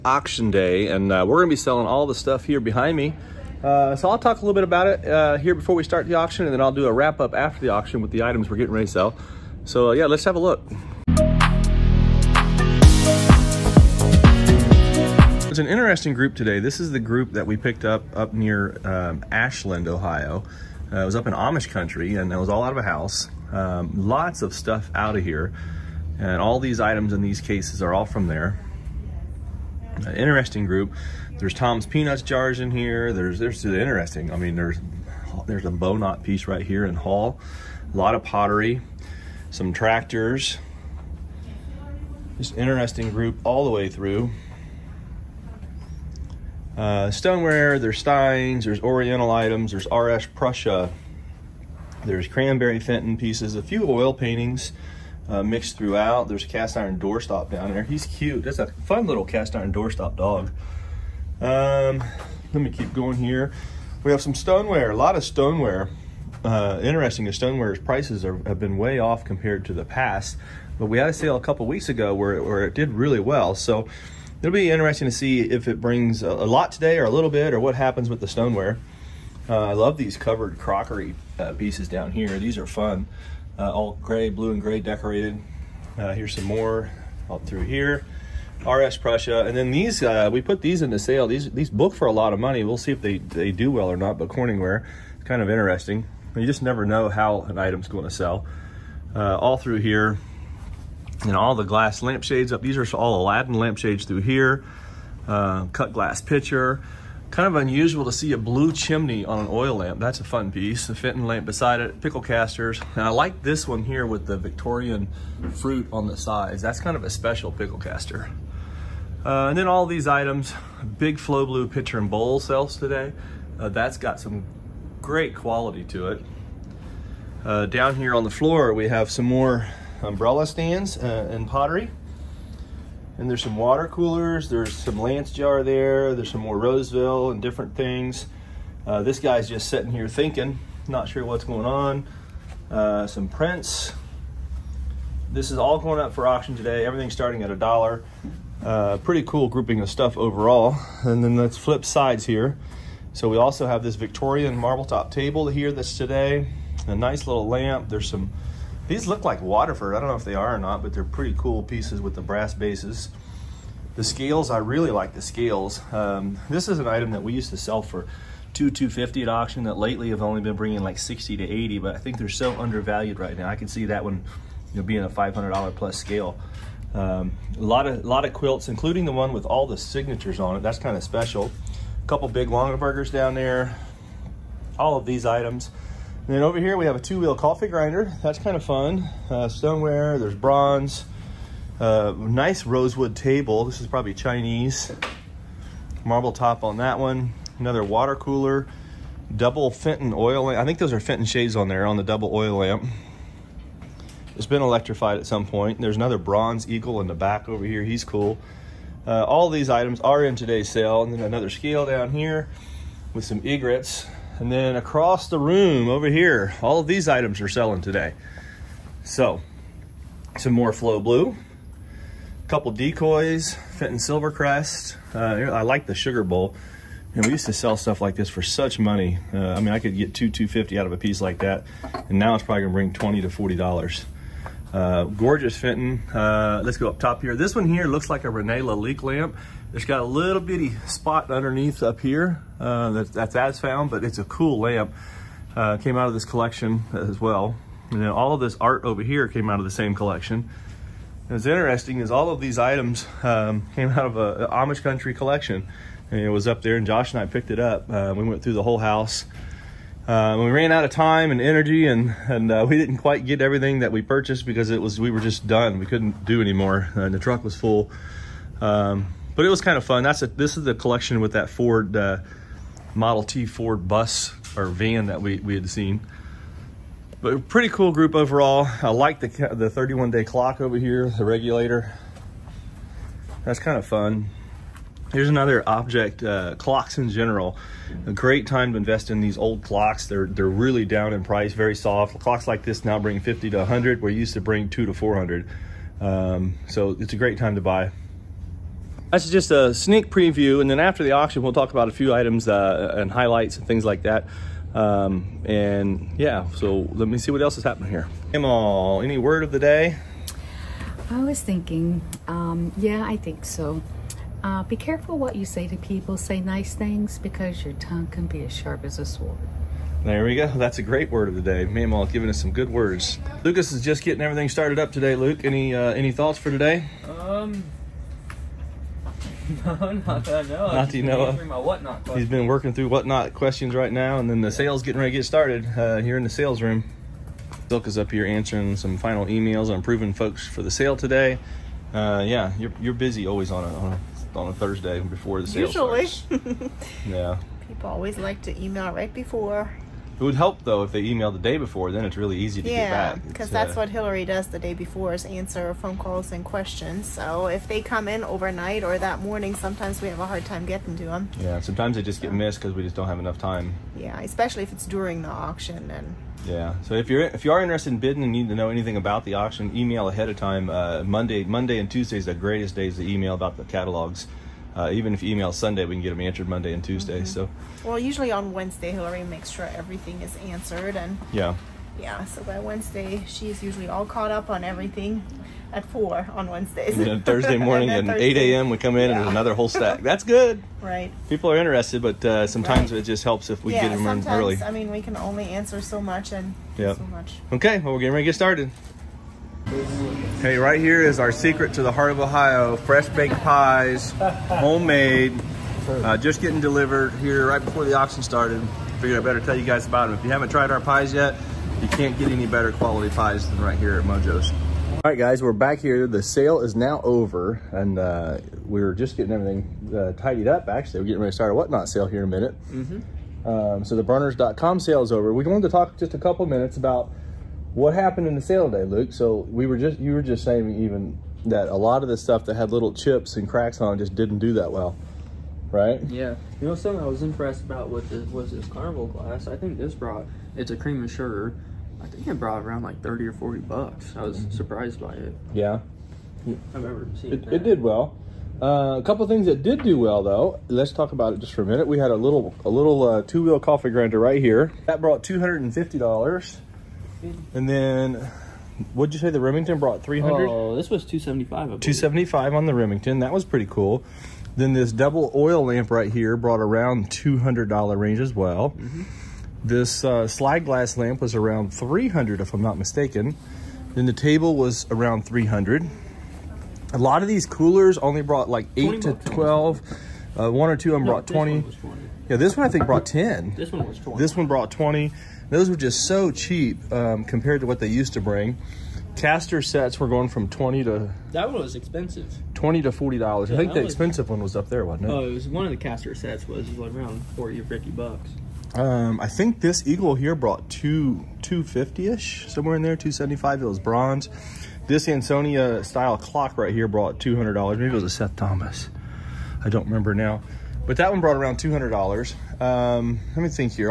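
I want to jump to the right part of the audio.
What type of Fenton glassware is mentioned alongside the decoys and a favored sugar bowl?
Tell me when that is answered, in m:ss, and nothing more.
3:43.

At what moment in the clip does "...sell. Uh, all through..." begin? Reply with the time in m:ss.
1:38.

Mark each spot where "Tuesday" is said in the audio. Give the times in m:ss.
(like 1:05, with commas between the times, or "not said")
6:11, 6:16.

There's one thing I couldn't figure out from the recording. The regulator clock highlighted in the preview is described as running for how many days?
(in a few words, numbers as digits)
31.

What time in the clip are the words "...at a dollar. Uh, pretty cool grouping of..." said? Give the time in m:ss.
2:27.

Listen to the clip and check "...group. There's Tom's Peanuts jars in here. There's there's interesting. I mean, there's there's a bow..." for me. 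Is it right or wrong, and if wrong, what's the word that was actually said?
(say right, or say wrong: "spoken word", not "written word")
right.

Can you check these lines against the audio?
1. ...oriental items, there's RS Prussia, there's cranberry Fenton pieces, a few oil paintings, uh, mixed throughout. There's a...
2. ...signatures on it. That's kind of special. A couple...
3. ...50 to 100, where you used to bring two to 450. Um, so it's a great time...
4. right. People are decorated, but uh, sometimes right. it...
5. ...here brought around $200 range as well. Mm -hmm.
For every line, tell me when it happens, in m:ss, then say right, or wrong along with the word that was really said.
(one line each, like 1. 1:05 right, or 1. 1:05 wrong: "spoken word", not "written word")
1. 0:48 right
2. 2:59 right
3. 4:53 wrong: "400", not "450"
4. 6:30 wrong: "interested", not "decorated"
5. 7:46 right.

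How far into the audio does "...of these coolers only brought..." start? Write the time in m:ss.
7:57.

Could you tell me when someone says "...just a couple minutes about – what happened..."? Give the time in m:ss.
7:06.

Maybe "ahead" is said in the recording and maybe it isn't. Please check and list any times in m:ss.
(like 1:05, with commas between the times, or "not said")
6:10.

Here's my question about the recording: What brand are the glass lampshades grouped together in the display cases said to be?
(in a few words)
Aladdin.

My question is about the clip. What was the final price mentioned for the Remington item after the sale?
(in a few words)
$275.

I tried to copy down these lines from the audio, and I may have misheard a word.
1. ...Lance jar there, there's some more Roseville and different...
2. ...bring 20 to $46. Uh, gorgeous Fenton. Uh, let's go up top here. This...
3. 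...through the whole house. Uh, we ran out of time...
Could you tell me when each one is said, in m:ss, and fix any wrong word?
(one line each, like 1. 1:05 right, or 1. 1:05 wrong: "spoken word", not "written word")
1. 2:14 right
2. 3:52 wrong: "40", not "46"
3. 4:18 right.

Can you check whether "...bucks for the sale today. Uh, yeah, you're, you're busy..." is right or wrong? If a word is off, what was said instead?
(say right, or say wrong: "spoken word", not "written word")
wrong: "folks", not "bucks".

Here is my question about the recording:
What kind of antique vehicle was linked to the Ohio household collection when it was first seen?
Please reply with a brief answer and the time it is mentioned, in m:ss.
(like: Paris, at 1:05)
Model T Ford bus, at 4:32.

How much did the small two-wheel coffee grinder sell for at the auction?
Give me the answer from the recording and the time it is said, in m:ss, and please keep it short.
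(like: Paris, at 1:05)
$250, at 7:35.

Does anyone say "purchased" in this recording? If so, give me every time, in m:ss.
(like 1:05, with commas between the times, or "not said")
4:24.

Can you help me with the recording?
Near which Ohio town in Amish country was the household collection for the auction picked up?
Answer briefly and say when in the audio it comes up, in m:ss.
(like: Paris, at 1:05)
Ashland, at 0:19.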